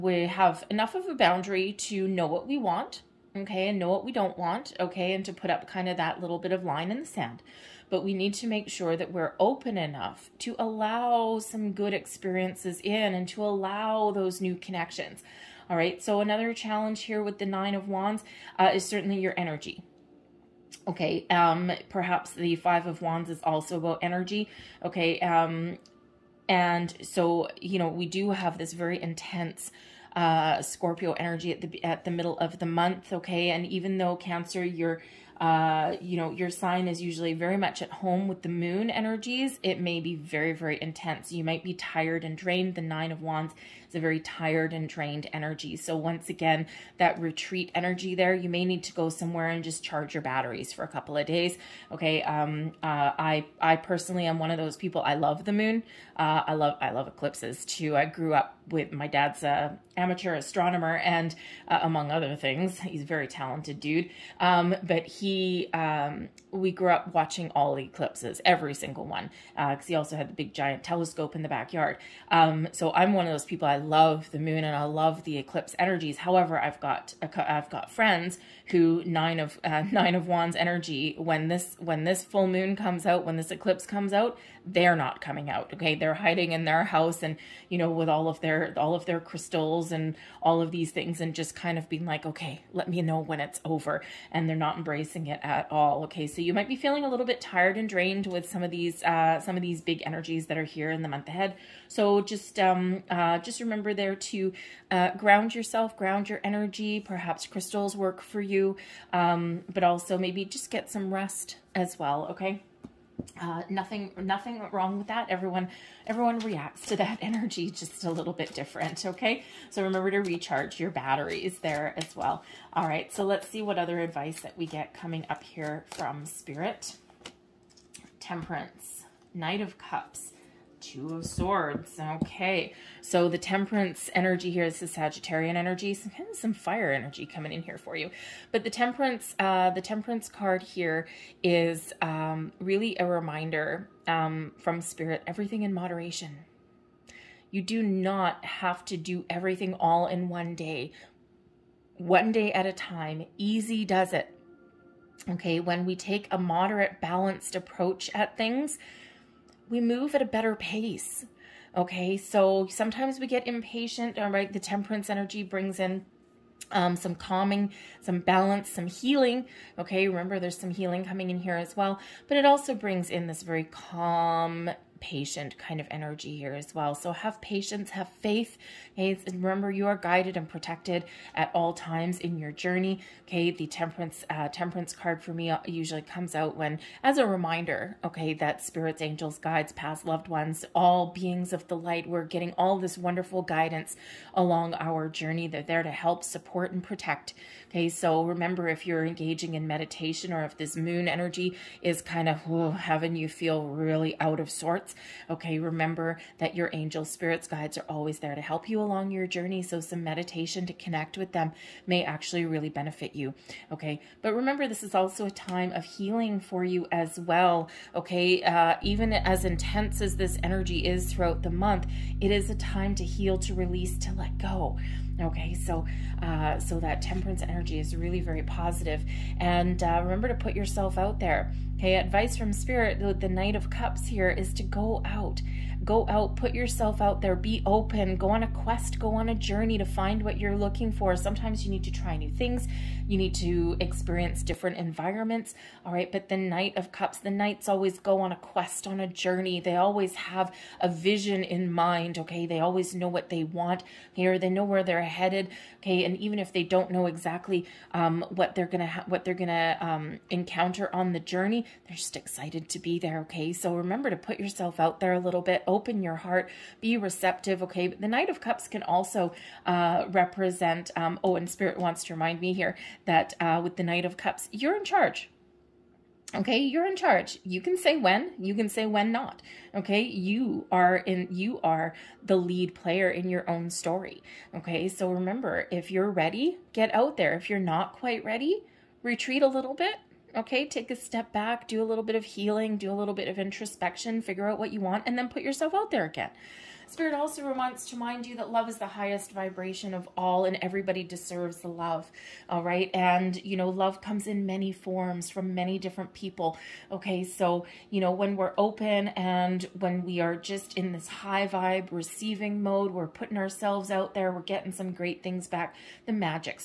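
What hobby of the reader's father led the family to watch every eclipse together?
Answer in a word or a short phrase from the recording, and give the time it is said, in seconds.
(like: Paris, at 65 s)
Amateur astronomer, at 59 s.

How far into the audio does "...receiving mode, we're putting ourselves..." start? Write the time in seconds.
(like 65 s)
311 s.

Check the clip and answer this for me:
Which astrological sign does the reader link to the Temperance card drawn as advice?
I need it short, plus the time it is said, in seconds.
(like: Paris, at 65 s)
Sagittarian, at 134 s.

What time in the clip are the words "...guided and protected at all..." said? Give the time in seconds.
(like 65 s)
179 s.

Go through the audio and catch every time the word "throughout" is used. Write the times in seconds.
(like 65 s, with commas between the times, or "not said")
221 s.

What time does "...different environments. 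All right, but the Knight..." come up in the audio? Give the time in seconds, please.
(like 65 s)
244 s.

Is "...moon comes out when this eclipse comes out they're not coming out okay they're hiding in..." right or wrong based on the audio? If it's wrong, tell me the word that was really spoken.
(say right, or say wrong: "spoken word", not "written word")
right.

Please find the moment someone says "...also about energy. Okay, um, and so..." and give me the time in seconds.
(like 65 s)
23 s.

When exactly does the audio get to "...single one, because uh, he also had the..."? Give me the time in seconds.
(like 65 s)
68 s.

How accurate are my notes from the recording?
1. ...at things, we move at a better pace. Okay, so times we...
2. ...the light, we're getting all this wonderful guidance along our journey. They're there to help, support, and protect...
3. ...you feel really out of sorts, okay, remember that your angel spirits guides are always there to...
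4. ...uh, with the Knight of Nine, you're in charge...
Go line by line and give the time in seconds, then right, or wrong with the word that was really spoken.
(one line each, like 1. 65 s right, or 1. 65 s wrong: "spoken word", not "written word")
1. 158 s wrong: "sometimes", not "times"
2. 191 s right
3. 203 s right
4. 273 s wrong: "Cups", not "Nine".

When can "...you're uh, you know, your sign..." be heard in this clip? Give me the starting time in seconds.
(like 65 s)
34 s.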